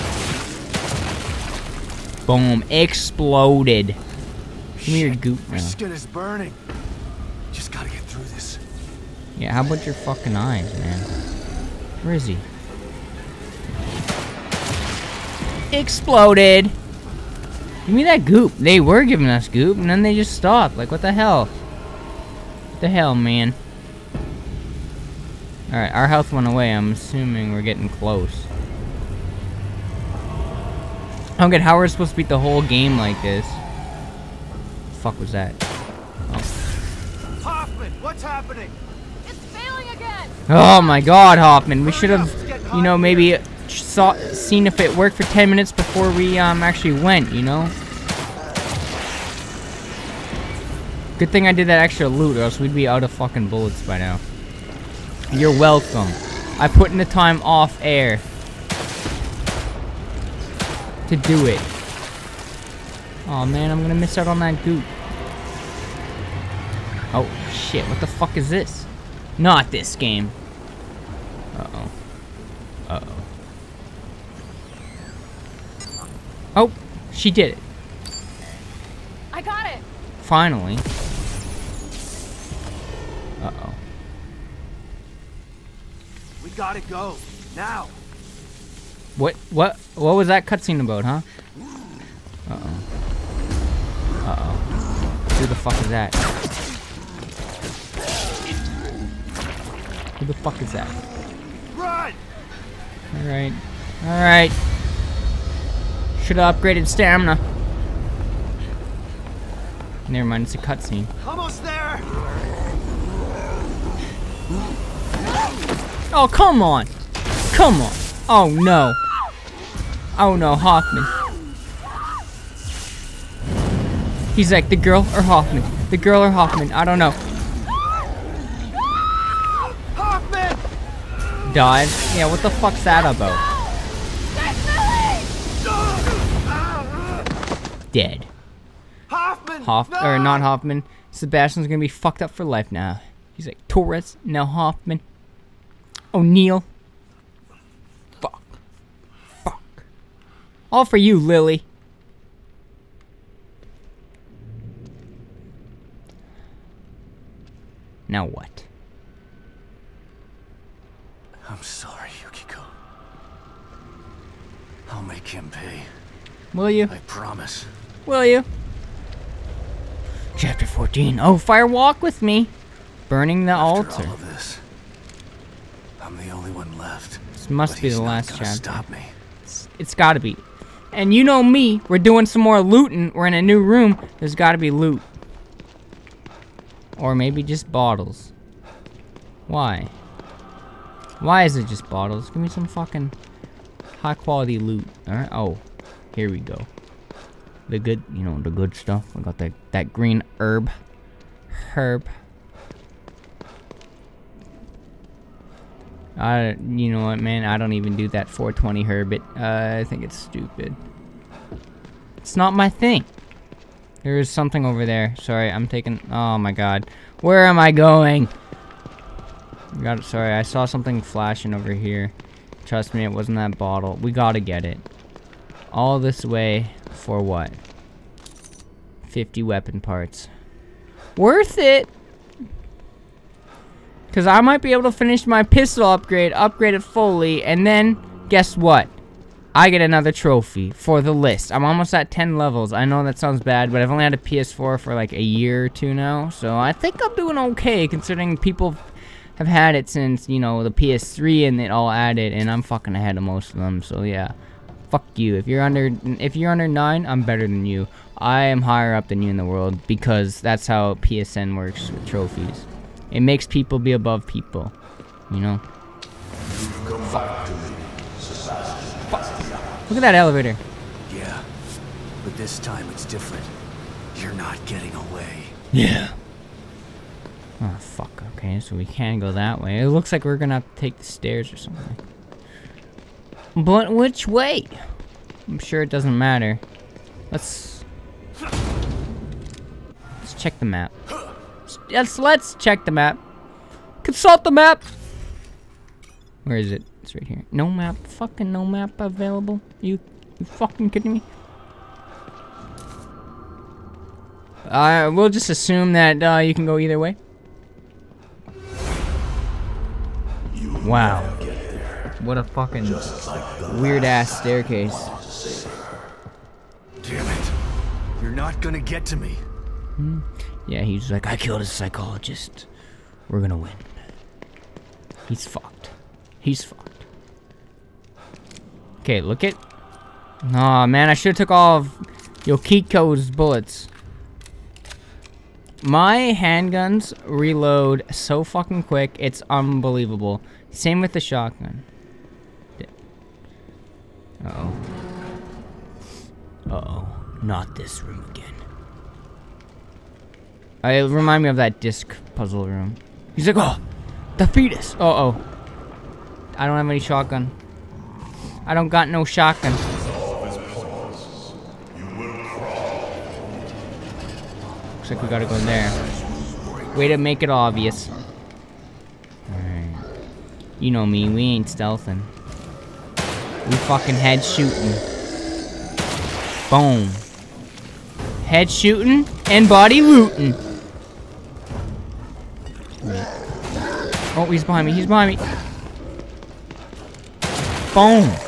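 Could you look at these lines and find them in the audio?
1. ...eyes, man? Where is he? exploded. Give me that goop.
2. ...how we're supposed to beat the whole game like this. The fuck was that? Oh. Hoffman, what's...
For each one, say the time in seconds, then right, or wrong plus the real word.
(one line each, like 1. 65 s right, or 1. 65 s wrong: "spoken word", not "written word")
1. 10 s right
2. 31 s right.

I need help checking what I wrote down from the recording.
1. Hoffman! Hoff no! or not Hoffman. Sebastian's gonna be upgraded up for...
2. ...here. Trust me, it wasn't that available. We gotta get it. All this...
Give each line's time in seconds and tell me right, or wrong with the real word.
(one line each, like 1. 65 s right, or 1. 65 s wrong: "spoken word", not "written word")
1. 139 s wrong: "fucked", not "upgraded"
2. 221 s wrong: "bottle", not "available".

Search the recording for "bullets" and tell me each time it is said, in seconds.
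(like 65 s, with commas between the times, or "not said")
53 s, 333 s.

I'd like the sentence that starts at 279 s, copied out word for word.
It looks like we're gonna have to take the stairs or something.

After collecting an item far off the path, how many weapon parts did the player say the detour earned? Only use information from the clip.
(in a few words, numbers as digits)
50.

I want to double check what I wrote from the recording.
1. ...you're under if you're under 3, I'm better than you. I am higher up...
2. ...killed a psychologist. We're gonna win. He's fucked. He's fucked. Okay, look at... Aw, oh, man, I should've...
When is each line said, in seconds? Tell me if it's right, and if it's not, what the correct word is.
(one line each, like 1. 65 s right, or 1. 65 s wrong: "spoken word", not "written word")
1. 255 s wrong: "9", not "3"
2. 321 s right.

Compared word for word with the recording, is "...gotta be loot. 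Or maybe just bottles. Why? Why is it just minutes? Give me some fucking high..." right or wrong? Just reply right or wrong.
wrong.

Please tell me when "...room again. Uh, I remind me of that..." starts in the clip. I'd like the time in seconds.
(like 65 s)
348 s.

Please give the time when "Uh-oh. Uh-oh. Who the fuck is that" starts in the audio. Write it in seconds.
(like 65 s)
92 s.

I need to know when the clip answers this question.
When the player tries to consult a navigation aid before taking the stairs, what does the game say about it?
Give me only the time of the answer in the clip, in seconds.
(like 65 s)
298 s.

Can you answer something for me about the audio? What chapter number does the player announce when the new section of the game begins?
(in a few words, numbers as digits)
14.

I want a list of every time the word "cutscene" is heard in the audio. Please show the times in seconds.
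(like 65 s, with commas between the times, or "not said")
90 s, 110 s.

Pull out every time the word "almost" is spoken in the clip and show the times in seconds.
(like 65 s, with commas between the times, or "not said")
111 s, 241 s.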